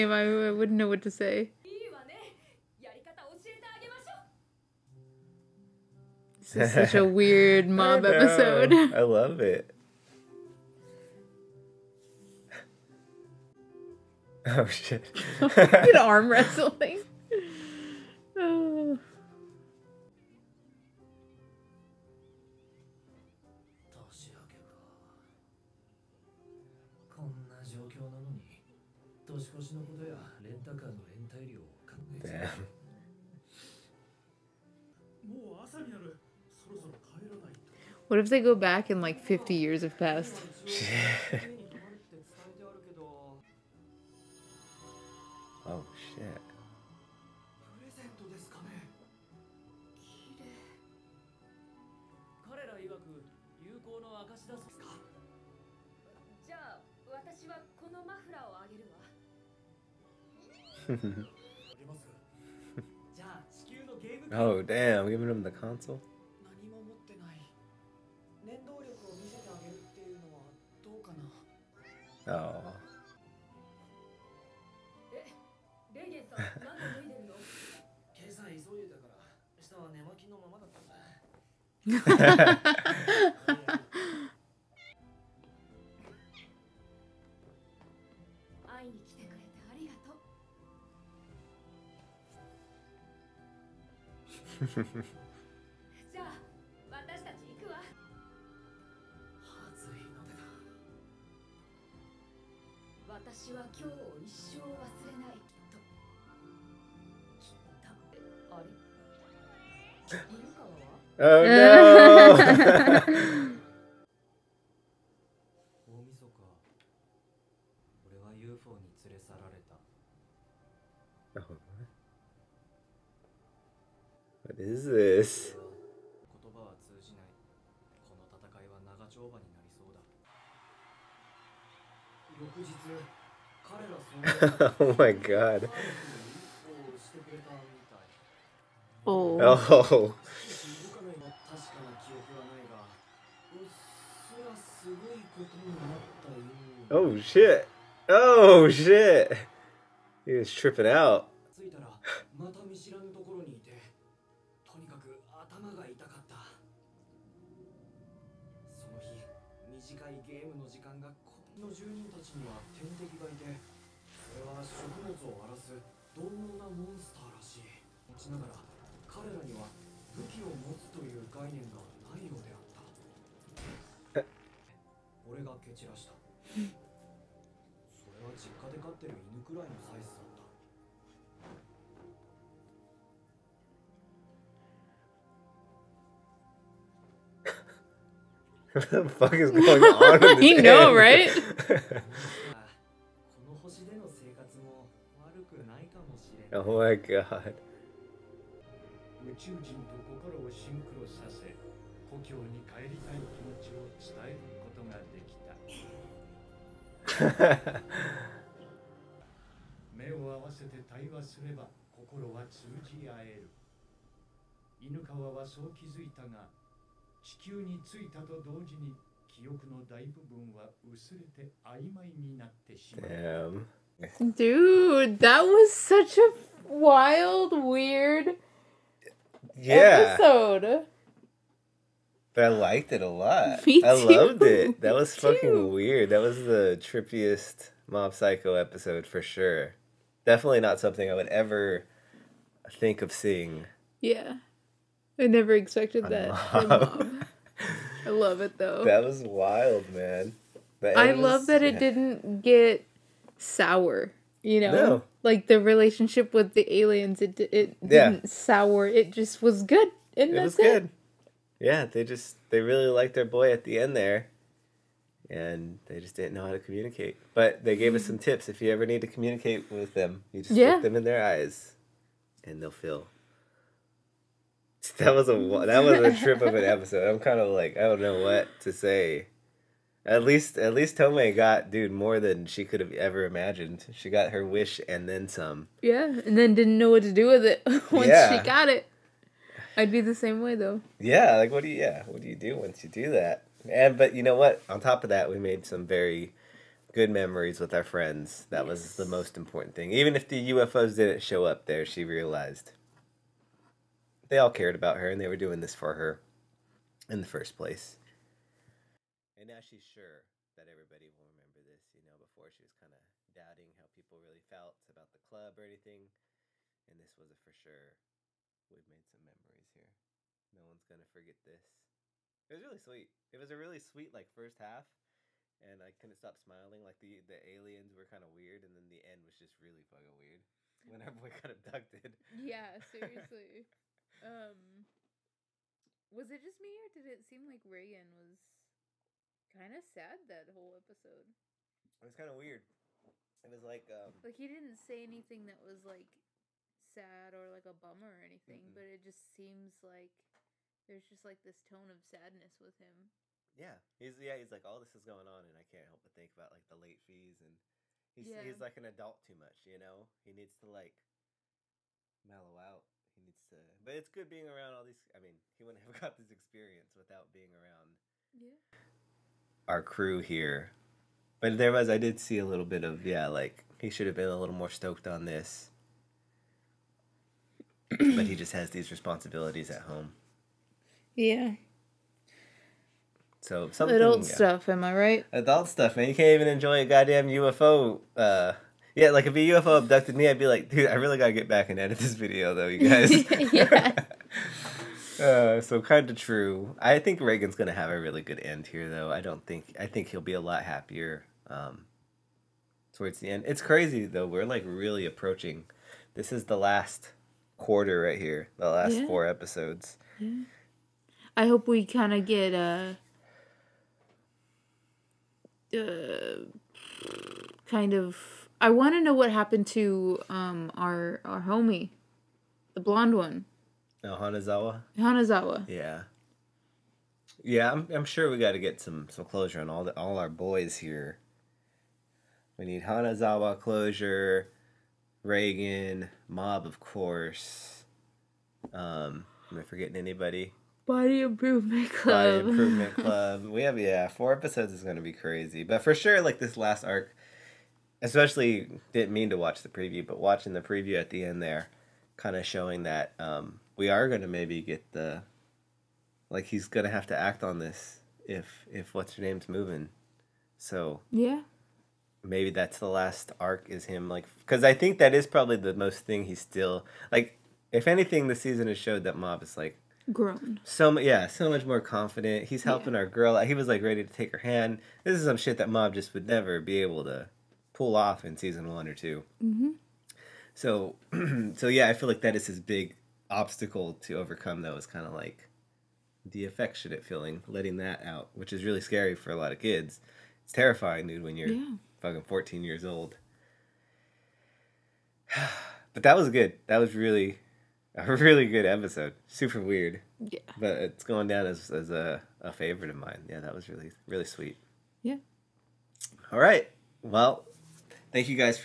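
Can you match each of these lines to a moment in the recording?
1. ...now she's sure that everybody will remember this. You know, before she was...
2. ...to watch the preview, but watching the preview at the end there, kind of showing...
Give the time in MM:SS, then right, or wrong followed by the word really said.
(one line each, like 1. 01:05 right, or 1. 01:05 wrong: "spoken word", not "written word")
1. 05:09 right
2. 07:29 right.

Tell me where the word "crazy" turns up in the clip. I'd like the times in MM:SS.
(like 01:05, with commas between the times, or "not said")
06:43, 07:25.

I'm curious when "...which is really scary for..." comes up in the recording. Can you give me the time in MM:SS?
08:08.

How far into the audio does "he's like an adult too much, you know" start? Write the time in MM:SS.
05:58.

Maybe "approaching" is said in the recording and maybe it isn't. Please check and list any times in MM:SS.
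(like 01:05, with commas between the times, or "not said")
06:45.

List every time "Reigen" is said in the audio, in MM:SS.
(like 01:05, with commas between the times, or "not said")
05:37, 06:37, 07:15.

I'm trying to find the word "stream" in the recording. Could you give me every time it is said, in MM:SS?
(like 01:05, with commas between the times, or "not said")
not said.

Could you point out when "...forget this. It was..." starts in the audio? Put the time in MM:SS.
05:21.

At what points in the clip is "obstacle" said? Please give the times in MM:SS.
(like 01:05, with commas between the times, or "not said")
08:03.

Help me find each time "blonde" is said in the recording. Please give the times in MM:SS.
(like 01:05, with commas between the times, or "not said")
07:02.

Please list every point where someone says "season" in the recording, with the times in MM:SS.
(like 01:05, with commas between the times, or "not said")
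07:48, 07:58.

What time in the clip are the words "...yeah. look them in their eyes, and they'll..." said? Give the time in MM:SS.
04:30.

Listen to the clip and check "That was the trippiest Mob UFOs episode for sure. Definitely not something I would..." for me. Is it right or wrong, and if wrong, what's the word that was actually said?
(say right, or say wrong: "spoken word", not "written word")
wrong: "Psycho", not "UFOs".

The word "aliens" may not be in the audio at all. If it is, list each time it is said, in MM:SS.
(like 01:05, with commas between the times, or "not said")
04:16, 05:27.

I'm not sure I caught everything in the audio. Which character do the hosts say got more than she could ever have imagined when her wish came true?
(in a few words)
Tome.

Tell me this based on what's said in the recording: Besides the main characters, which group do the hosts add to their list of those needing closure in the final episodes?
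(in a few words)
Body Improvement Club.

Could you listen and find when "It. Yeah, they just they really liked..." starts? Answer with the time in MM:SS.
04:20.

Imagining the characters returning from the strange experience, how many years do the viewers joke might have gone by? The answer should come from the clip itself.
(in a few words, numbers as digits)
50.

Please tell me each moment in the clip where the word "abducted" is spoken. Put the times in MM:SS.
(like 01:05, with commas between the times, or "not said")
05:31, 06:29.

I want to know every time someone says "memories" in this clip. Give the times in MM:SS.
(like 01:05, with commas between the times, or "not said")
04:57, 05:19.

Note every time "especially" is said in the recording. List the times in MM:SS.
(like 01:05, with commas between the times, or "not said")
07:28.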